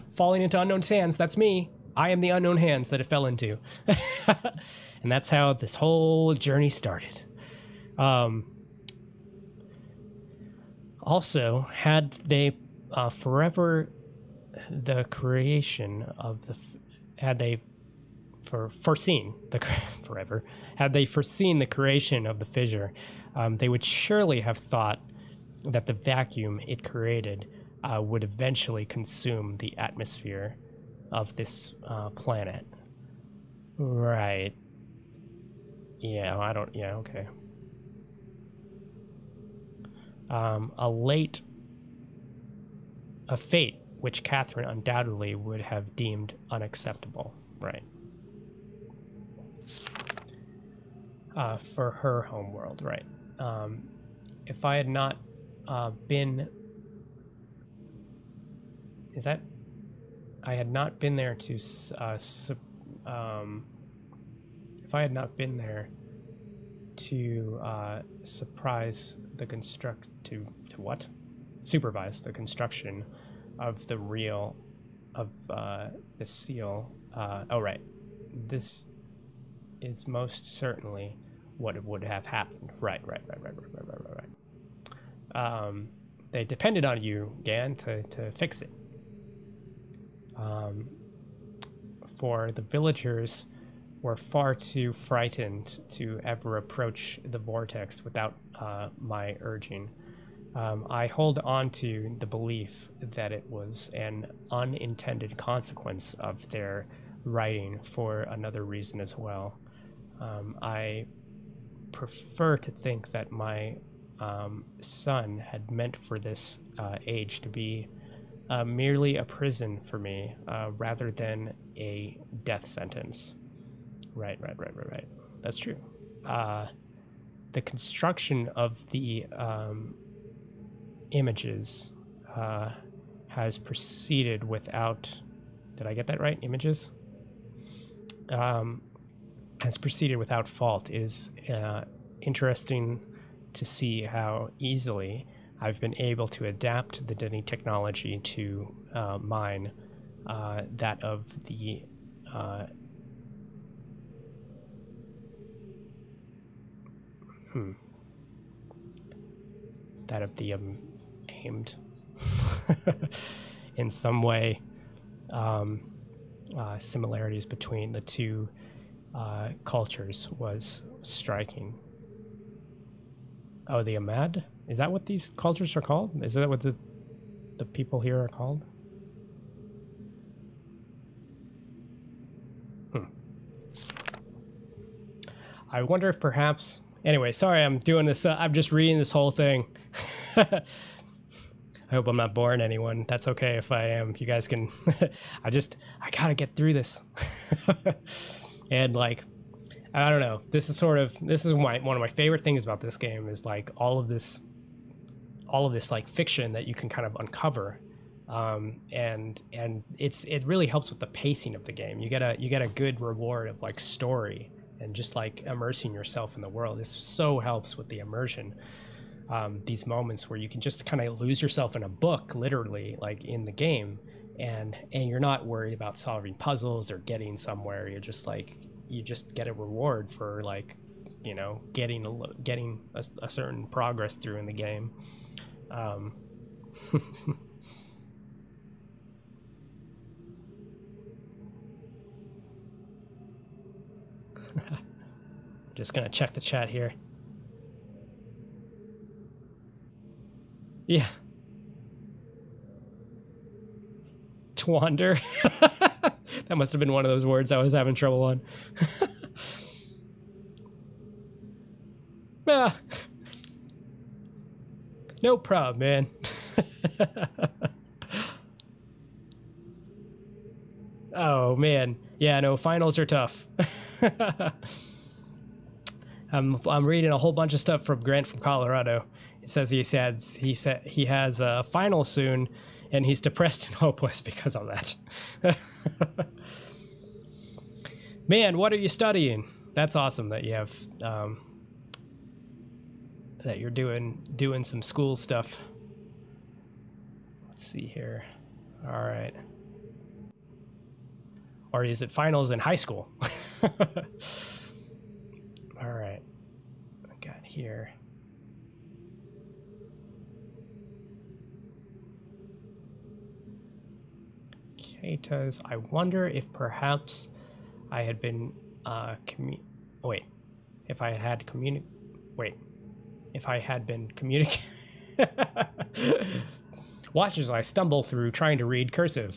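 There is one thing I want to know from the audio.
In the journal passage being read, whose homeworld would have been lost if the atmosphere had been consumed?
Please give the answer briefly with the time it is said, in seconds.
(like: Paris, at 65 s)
Catherine, at 44 s.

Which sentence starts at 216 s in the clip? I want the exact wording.
This so helps with the immersion.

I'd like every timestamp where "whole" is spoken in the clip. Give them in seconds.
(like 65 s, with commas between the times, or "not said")
5 s, 189 s, 277 s.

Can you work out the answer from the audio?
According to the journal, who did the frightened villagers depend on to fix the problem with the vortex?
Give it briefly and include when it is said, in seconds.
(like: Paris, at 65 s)
Gehn, at 87 s.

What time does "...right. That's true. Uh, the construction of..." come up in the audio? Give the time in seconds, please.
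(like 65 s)
124 s.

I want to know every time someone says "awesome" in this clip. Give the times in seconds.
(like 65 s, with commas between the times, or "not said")
289 s.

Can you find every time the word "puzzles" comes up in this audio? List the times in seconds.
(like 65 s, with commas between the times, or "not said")
226 s.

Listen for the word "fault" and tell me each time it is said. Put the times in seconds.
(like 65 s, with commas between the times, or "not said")
140 s.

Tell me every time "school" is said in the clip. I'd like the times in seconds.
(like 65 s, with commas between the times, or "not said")
294 s, 302 s.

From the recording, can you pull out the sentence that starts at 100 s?
Um, I hold on to the belief that it was an unintended consequence of their writing for another reason as well.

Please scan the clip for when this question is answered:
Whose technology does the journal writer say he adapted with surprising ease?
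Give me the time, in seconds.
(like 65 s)
147 s.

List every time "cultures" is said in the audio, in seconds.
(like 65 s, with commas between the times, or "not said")
169 s, 175 s.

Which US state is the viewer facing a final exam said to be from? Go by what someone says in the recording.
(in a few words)
Colorado.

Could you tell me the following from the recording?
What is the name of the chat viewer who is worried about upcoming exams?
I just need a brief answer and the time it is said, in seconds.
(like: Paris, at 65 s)
Grant, at 278 s.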